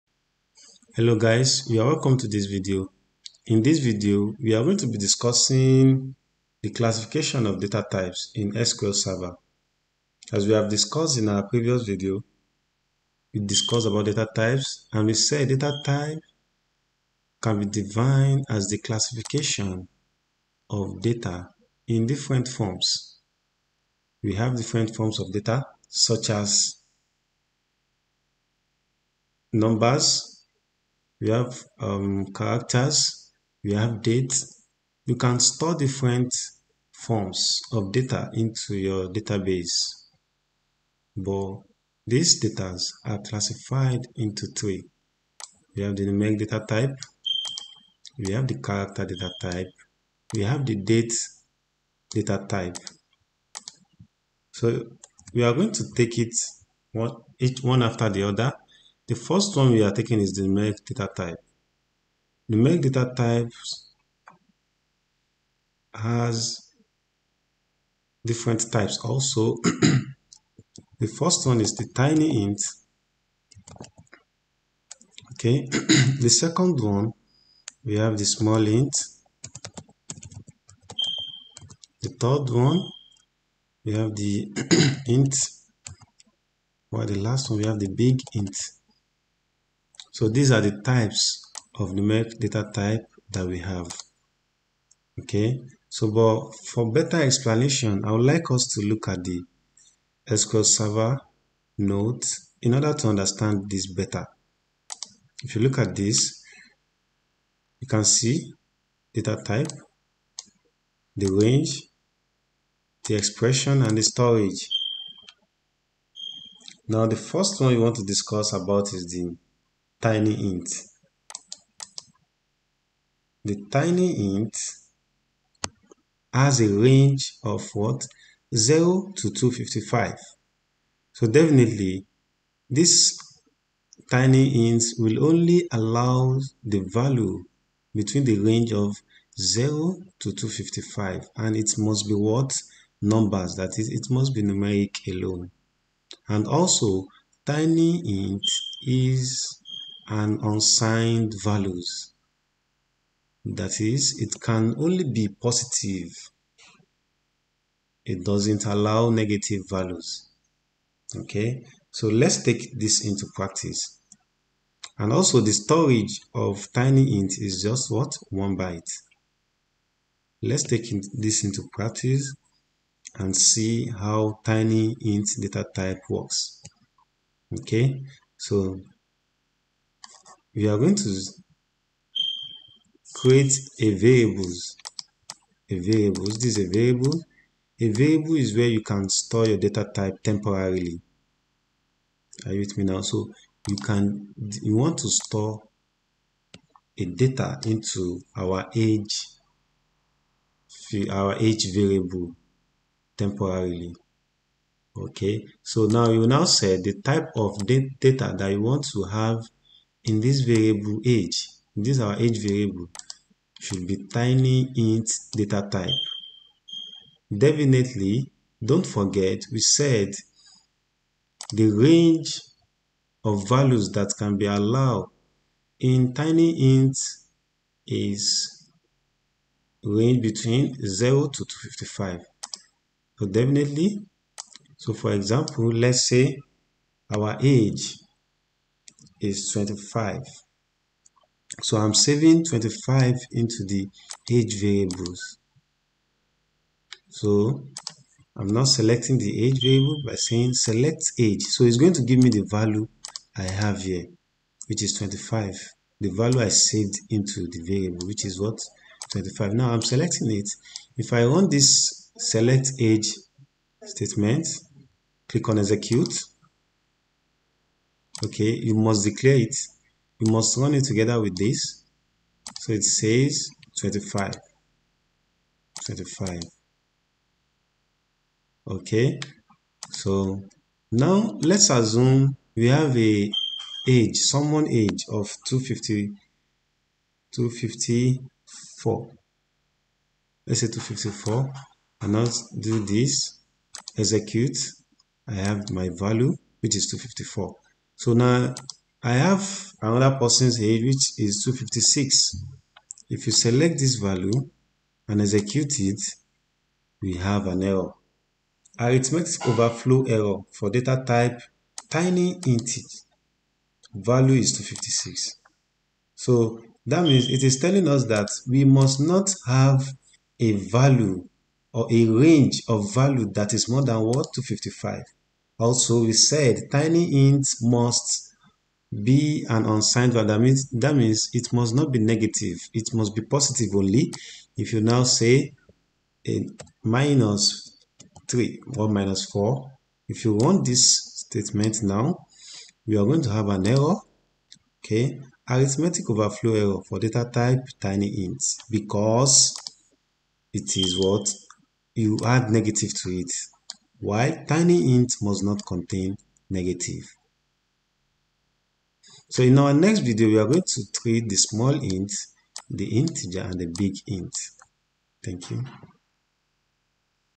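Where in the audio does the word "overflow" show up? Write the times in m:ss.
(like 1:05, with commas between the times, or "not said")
5:09, 5:46.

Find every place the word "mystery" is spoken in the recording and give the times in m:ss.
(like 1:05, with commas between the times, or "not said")
not said.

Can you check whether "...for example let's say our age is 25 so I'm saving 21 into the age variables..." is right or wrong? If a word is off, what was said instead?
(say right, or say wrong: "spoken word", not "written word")
wrong: "25", not "21".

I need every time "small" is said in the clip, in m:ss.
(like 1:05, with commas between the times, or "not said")
1:18, 6:01.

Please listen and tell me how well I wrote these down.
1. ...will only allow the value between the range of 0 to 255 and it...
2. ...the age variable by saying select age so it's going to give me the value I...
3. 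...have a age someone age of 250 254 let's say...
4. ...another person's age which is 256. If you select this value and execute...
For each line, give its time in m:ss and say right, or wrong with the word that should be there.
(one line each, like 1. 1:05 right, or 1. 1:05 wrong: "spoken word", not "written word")
1. 2:14 right
2. 4:09 right
3. 4:42 right
4. 4:59 right.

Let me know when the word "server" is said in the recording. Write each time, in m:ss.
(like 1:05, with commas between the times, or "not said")
0:08, 1:40.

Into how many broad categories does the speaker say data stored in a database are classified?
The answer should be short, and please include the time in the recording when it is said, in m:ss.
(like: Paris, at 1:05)
3, at 0:44.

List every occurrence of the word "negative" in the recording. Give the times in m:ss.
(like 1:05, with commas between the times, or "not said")
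2:39, 5:31, 5:52, 5:56.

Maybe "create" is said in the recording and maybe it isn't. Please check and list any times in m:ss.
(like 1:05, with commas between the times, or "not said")
3:03.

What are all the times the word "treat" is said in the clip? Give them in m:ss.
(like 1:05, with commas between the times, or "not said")
6:00.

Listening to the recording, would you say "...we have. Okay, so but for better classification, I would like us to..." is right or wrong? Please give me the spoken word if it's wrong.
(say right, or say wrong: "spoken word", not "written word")
wrong: "explanation", not "classification".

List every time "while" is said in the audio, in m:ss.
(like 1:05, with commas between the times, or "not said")
1:26, 5:54.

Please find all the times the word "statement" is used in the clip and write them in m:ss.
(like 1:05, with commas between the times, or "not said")
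4:23, 5:41.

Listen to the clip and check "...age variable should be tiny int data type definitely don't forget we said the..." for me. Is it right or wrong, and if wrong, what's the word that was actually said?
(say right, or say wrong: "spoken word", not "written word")
right.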